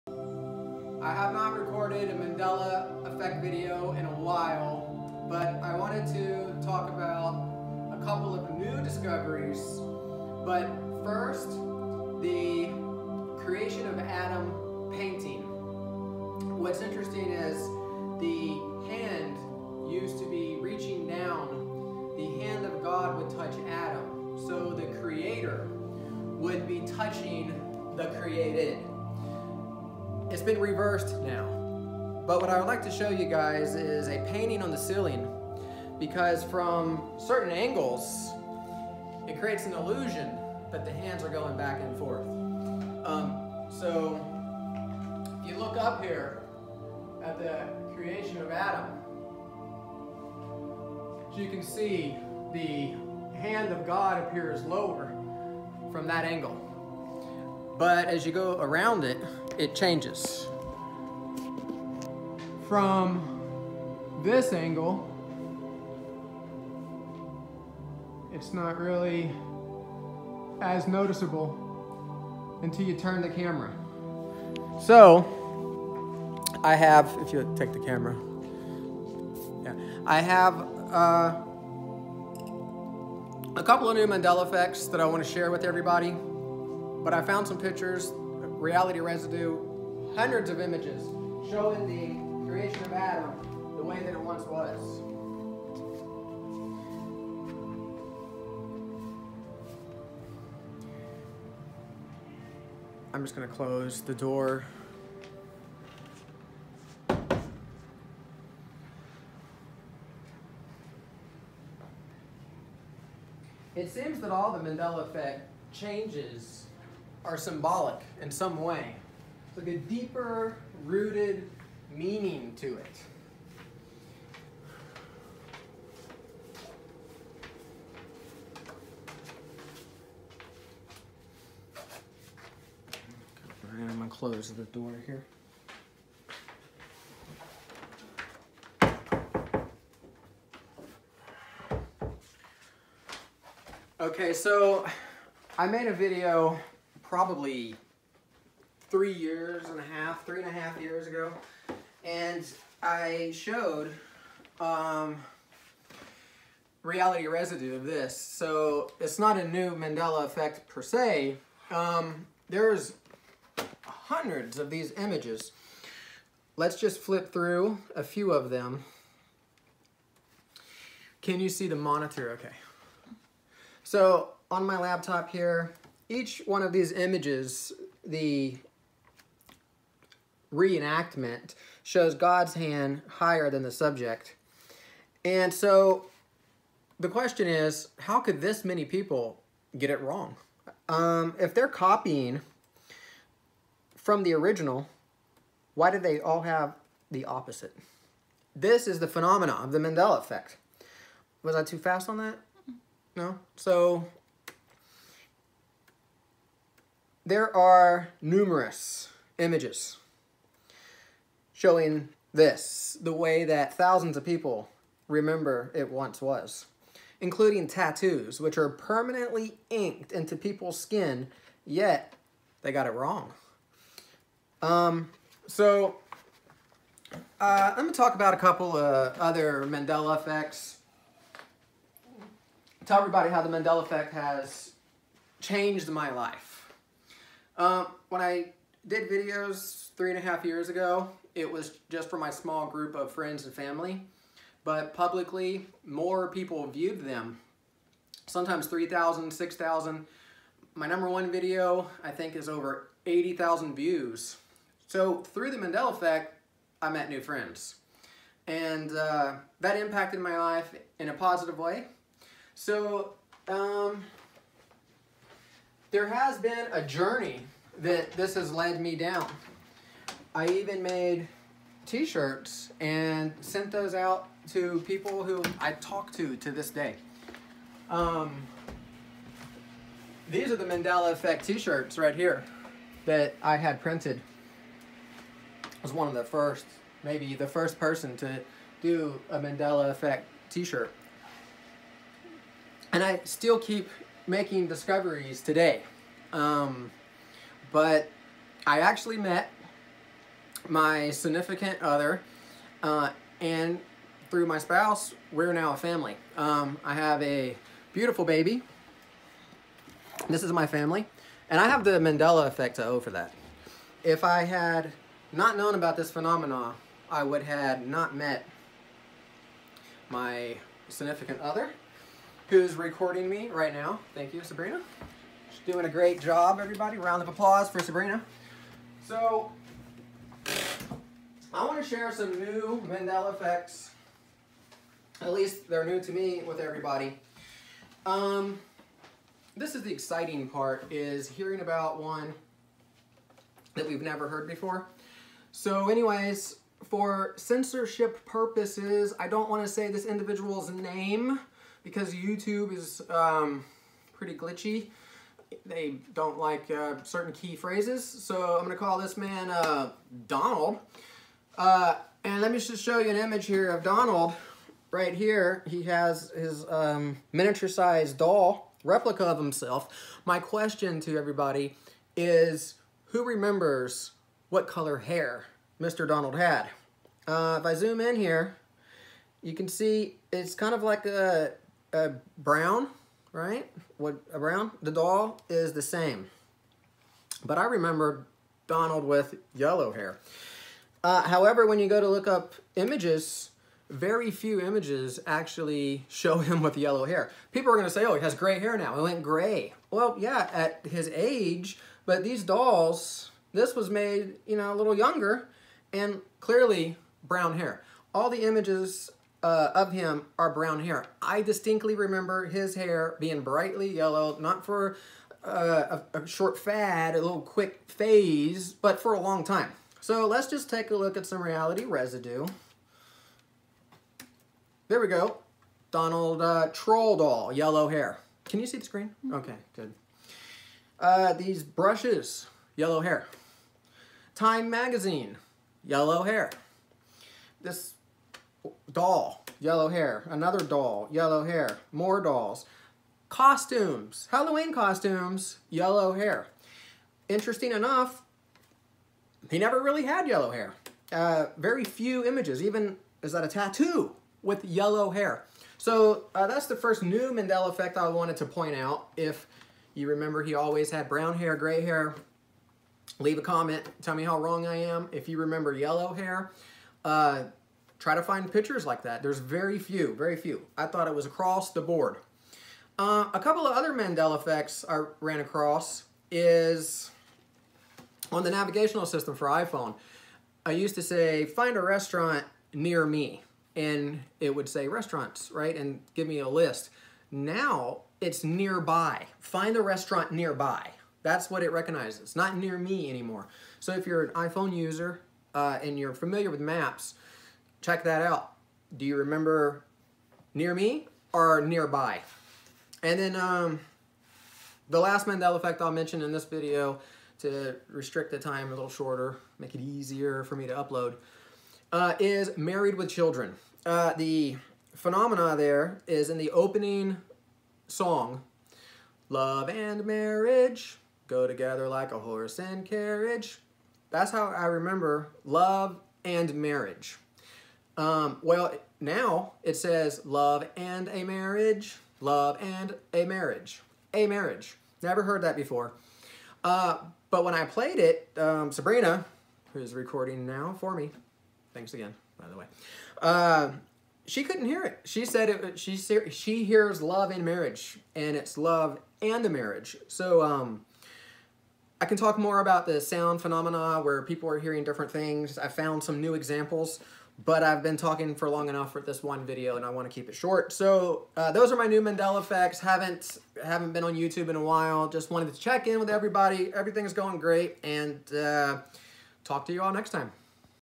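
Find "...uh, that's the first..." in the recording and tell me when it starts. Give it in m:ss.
7:36.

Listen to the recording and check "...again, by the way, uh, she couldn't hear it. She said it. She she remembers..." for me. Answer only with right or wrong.
wrong.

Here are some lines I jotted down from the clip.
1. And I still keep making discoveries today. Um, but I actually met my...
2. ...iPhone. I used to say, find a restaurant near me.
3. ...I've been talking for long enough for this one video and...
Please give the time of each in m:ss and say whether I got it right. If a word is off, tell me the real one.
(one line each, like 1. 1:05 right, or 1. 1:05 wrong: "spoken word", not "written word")
1. 4:52 right
2. 7:59 right
3. 9:17 right.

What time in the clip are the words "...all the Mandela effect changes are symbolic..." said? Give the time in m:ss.
1:54.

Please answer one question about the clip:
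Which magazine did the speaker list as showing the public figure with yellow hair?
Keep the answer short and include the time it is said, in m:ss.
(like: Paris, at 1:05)
Time Magazine, at 7:14.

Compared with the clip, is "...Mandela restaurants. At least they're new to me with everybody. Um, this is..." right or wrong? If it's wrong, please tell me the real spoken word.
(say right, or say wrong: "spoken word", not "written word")
wrong: "effects", not "restaurants".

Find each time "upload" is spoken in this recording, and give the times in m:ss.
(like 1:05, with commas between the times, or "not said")
8:30.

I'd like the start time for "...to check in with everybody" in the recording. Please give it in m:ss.
9:25.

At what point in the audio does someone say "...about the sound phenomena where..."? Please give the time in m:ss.
9:12.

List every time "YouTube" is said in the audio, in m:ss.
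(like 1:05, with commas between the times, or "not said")
5:52, 9:24.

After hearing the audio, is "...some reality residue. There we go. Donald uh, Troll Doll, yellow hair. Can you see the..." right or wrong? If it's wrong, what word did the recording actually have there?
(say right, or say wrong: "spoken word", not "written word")
right.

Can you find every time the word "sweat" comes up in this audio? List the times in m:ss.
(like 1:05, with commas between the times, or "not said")
not said.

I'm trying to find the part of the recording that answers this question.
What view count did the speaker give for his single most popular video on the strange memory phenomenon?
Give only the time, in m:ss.
4:12.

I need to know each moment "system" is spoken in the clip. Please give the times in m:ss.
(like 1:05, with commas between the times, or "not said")
7:59.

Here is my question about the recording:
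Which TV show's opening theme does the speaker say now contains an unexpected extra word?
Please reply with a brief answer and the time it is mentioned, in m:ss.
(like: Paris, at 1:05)
Married with Children, at 8:32.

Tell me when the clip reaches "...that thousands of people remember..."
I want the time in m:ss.
3:33.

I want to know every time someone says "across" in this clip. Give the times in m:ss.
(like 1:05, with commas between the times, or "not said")
7:51, 7:55.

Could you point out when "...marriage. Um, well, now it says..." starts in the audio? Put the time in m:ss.
8:46.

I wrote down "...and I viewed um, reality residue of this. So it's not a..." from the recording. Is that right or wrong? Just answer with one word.
wrong.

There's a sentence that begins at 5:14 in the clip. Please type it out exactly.
If I had not known about this phenomenon, I would have not met my significant other who's recording me right now.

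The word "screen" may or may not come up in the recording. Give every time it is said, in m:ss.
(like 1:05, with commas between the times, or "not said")
7:08.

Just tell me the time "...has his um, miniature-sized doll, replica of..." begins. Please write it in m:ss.
6:05.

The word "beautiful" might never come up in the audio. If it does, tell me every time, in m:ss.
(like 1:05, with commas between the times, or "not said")
5:07.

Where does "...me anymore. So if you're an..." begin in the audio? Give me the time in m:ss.
8:12.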